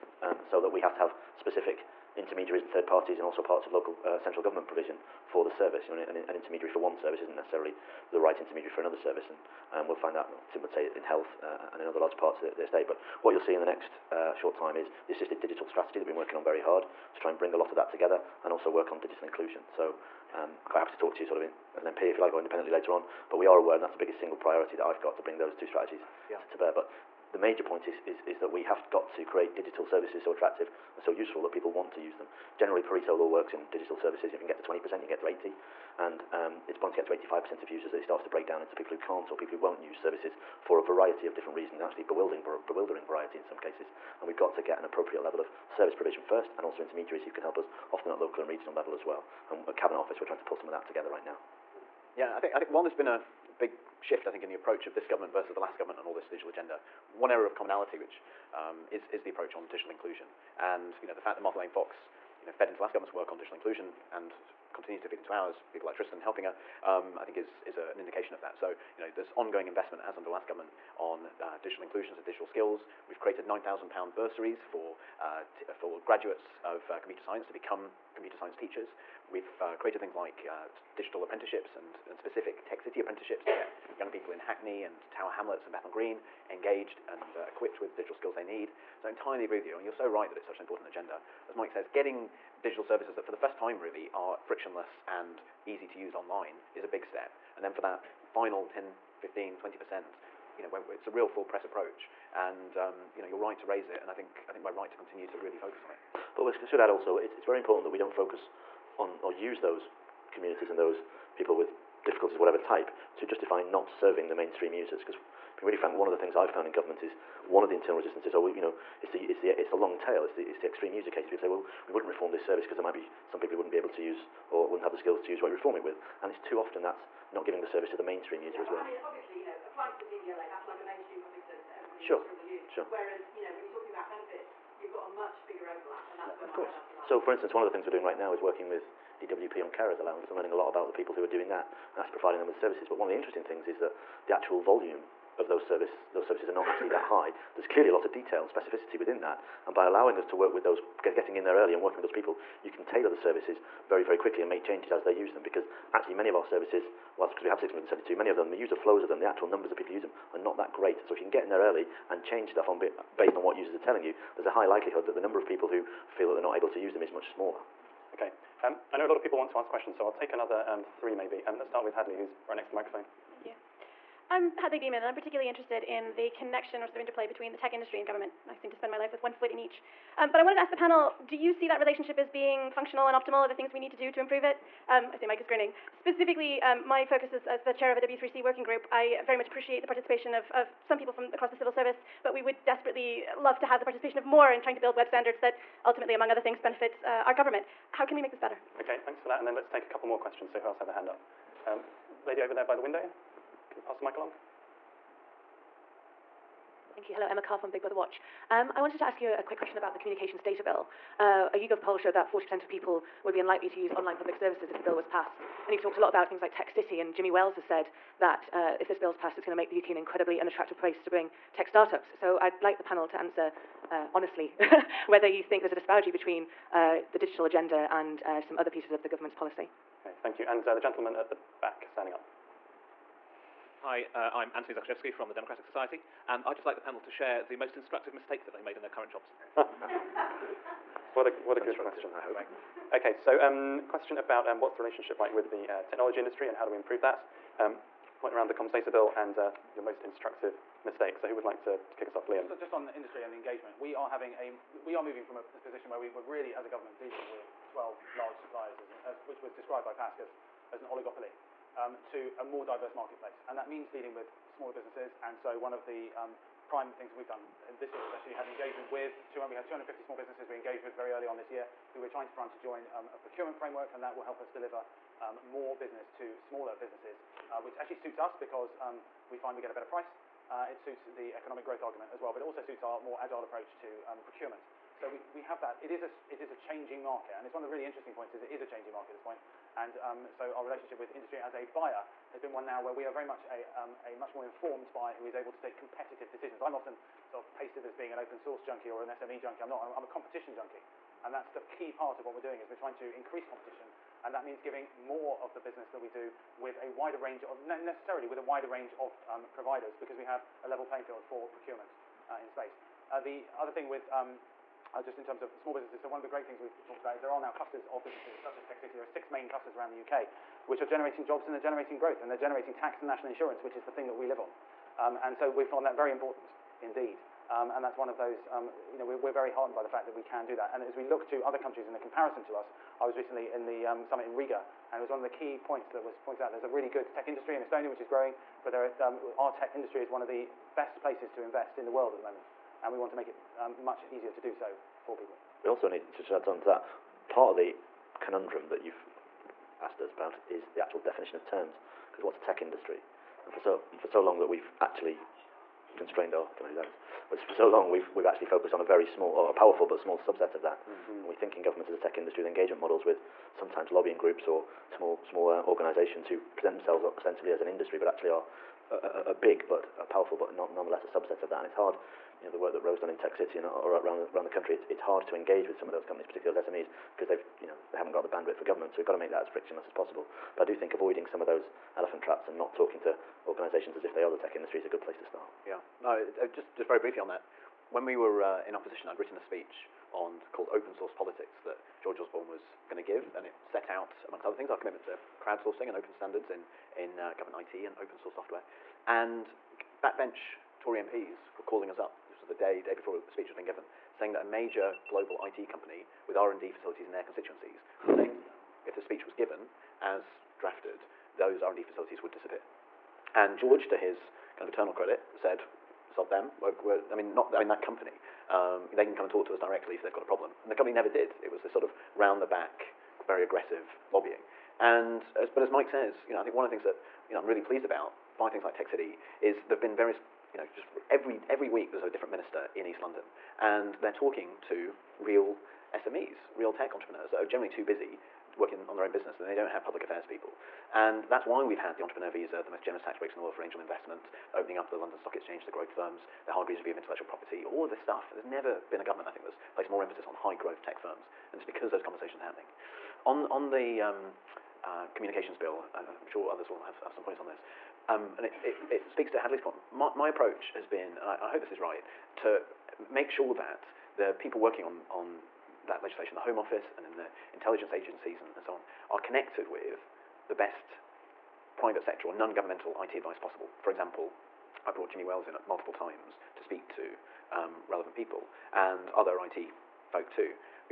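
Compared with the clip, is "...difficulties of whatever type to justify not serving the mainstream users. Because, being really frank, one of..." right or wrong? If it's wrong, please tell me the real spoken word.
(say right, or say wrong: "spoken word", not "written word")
right.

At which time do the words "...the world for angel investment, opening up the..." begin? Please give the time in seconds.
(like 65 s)
443 s.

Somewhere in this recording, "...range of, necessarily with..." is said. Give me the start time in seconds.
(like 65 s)
307 s.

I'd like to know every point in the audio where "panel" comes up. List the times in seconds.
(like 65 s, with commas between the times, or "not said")
180 s, 222 s, 236 s.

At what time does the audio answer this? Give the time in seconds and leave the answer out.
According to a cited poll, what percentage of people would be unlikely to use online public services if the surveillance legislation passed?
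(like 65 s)
212 s.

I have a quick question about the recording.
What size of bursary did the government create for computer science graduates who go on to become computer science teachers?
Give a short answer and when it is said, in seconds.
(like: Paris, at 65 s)
£9,000, at 73 s.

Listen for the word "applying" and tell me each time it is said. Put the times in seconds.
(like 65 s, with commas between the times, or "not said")
129 s.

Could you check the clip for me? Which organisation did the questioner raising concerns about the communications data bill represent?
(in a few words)
Big Brother Watch.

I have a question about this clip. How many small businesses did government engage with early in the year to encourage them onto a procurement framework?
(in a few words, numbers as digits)
250.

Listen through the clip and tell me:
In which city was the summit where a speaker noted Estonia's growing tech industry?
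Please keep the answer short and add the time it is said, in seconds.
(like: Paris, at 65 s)
Riga, at 334 s.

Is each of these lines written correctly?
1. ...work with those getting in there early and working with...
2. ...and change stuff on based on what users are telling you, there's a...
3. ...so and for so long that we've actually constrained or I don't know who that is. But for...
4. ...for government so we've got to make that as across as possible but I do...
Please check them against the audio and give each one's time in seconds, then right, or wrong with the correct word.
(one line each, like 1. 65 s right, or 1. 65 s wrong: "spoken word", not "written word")
1. 150 s right
2. 162 s right
3. 353 s right
4. 378 s wrong: "frictionless", not "across".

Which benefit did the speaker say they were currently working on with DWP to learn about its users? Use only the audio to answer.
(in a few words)
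Carers allowance.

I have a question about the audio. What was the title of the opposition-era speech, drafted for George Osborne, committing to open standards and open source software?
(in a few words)
Open Source Politics.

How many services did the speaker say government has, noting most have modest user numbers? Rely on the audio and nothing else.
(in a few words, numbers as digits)
672.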